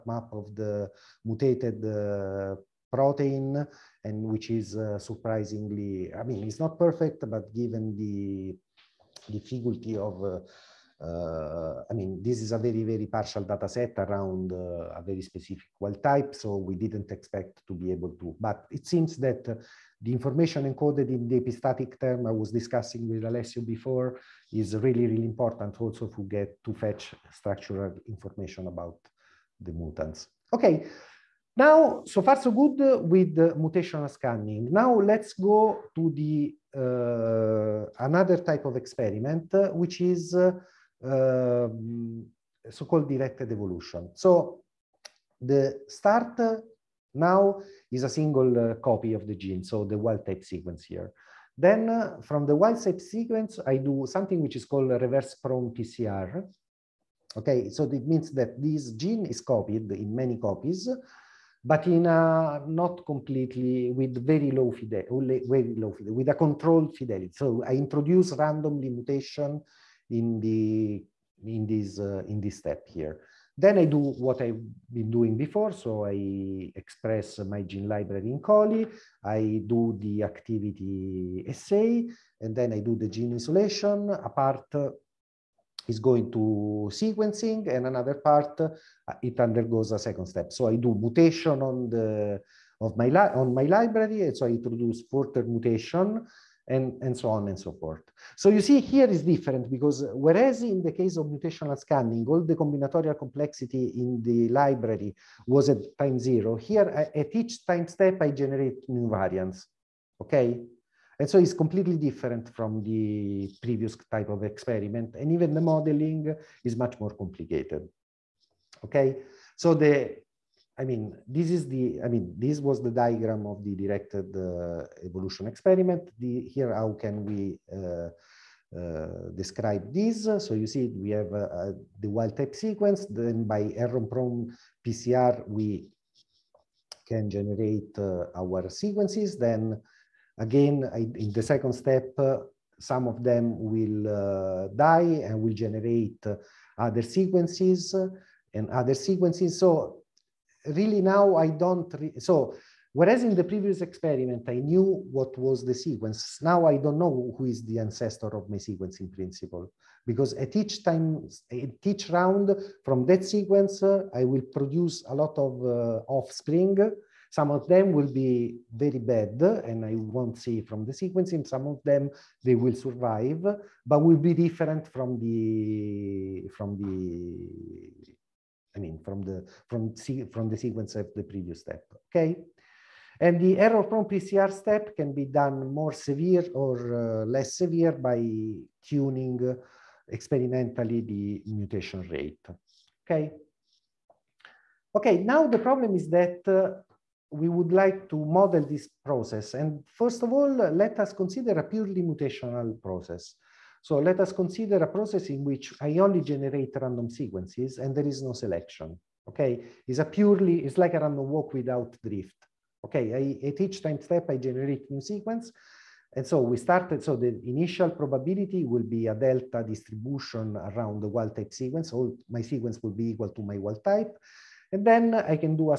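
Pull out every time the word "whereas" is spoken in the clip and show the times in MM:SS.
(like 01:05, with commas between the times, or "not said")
01:40, 02:32.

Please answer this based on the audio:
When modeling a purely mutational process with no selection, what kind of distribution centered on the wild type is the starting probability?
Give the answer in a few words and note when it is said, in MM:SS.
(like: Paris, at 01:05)
Delta distribution, at 03:39.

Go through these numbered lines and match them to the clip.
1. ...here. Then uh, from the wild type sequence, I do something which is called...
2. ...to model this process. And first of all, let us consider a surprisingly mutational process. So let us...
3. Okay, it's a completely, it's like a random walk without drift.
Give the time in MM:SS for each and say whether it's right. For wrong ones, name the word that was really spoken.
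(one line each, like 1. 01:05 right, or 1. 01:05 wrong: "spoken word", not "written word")
1. 00:50 right
2. 03:18 wrong: "purely", not "surprisingly"
3. 03:29 wrong: "purely", not "completely".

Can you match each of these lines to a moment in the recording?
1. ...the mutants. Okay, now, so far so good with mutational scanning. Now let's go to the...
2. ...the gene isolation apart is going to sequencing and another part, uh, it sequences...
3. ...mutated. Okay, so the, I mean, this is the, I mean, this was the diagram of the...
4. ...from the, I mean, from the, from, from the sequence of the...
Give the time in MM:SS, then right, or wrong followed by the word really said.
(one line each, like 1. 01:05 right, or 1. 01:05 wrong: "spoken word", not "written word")
1. 00:29 right
2. 01:22 wrong: "undergoes", not "sequences"
3. 01:57 wrong: "complicated", not "mutated"
4. 02:56 right.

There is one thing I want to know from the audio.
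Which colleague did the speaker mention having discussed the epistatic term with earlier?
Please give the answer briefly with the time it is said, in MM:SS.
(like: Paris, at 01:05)
Alessio, at 00:23.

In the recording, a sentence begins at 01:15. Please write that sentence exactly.
So I express my gene library in Coli.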